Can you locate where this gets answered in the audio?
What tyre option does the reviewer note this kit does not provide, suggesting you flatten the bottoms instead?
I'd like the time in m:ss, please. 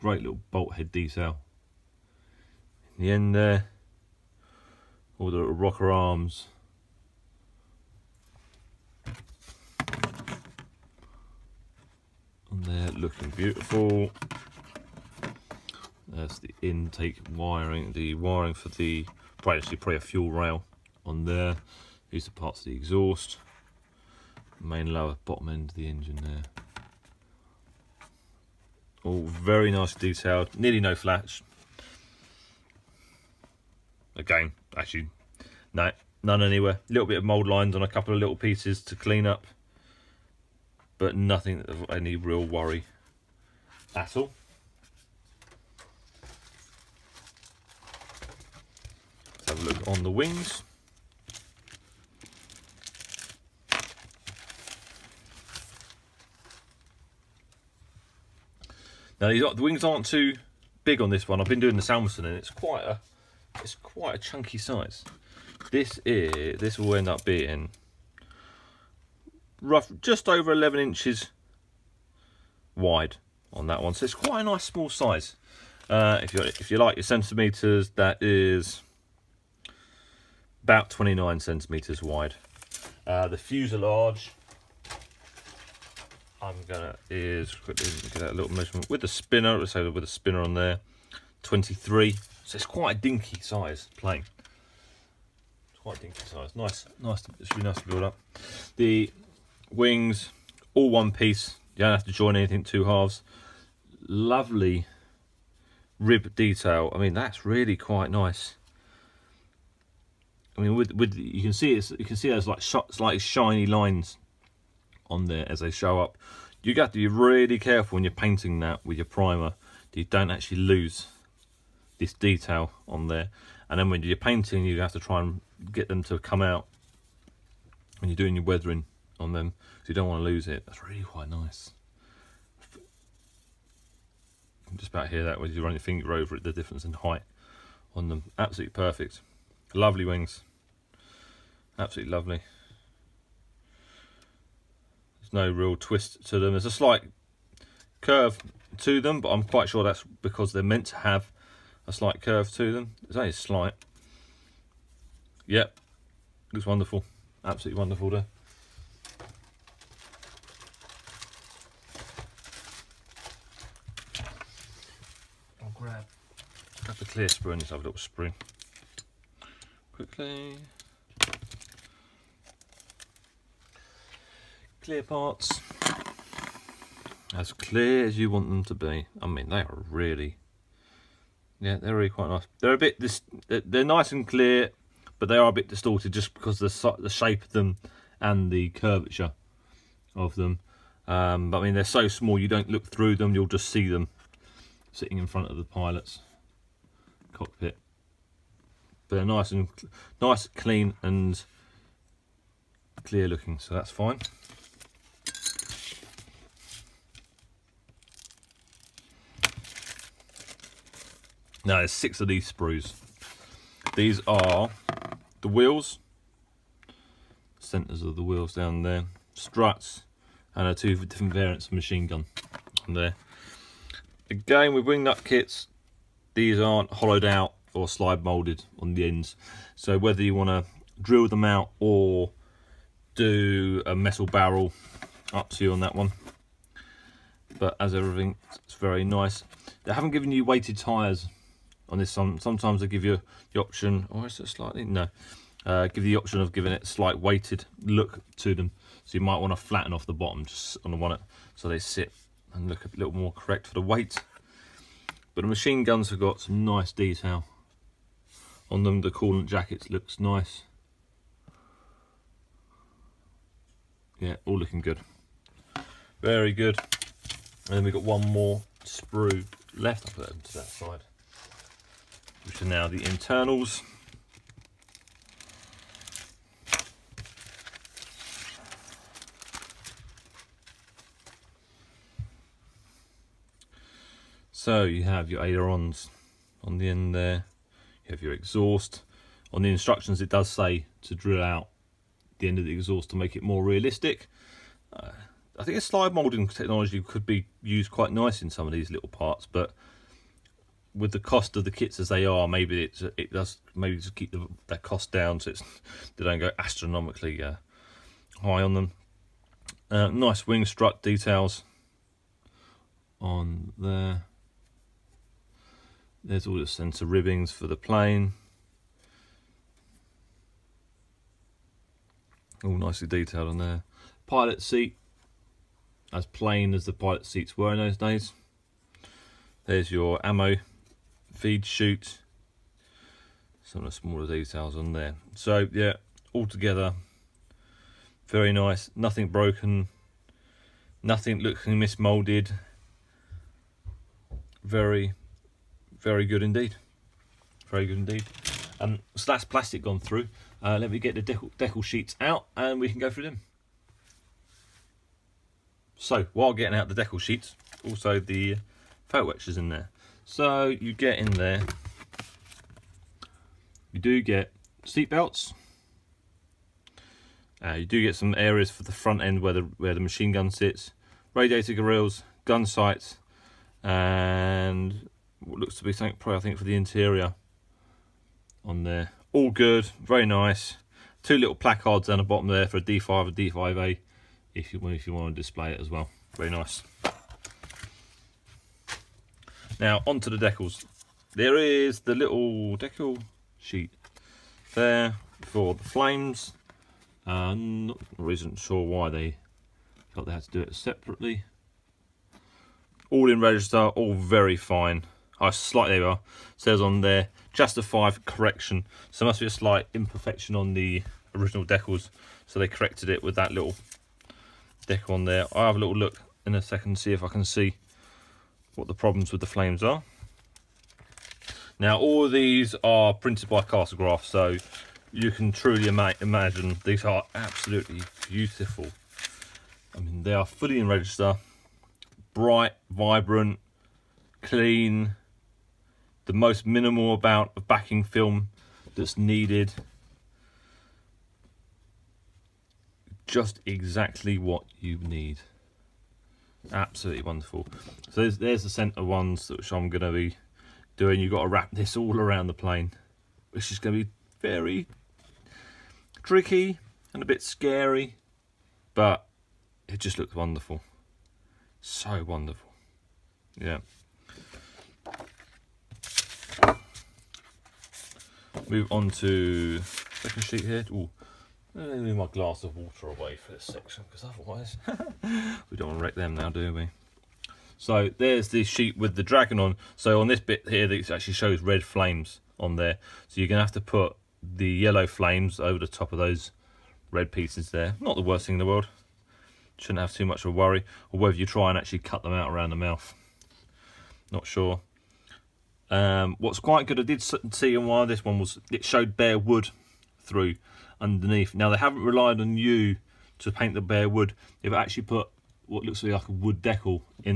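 4:00.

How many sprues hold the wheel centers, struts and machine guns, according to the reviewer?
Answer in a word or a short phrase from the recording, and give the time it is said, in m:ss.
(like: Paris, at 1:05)
6, at 3:31.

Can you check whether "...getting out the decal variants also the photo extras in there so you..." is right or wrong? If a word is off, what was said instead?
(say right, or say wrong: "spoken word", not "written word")
wrong: "sheets", not "variants".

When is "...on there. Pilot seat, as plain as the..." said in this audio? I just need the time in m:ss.
5:23.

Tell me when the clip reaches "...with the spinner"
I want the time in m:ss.
1:28.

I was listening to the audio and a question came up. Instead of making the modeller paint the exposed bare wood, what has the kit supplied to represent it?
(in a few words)
a wood decal.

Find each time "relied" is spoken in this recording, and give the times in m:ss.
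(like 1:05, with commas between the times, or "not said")
8:22.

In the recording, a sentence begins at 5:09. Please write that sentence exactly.
Uh, nice wing strut details on there.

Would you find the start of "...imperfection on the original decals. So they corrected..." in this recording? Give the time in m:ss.
6:49.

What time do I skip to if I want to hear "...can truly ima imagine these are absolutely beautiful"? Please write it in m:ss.
7:05.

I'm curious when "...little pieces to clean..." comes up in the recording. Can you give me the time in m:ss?
0:38.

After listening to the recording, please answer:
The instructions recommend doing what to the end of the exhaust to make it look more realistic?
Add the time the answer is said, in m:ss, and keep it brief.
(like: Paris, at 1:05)
drill out, at 4:51.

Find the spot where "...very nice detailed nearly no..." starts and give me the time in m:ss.
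0:29.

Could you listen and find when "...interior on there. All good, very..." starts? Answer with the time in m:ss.
6:16.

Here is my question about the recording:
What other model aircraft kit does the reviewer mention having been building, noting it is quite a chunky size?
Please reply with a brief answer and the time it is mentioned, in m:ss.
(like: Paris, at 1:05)
Salmson, at 1:01.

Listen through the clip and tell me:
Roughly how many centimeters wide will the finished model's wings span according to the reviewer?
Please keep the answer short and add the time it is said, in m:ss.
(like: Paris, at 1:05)
29, at 1:20.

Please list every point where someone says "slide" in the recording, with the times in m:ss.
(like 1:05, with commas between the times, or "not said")
3:47, 4:55.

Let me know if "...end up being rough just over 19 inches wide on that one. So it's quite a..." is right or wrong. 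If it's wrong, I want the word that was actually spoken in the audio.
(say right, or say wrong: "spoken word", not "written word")
wrong: "11", not "19".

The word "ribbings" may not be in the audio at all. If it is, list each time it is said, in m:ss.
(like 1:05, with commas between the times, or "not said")
5:17.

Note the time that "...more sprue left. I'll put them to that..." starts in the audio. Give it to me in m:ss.
4:28.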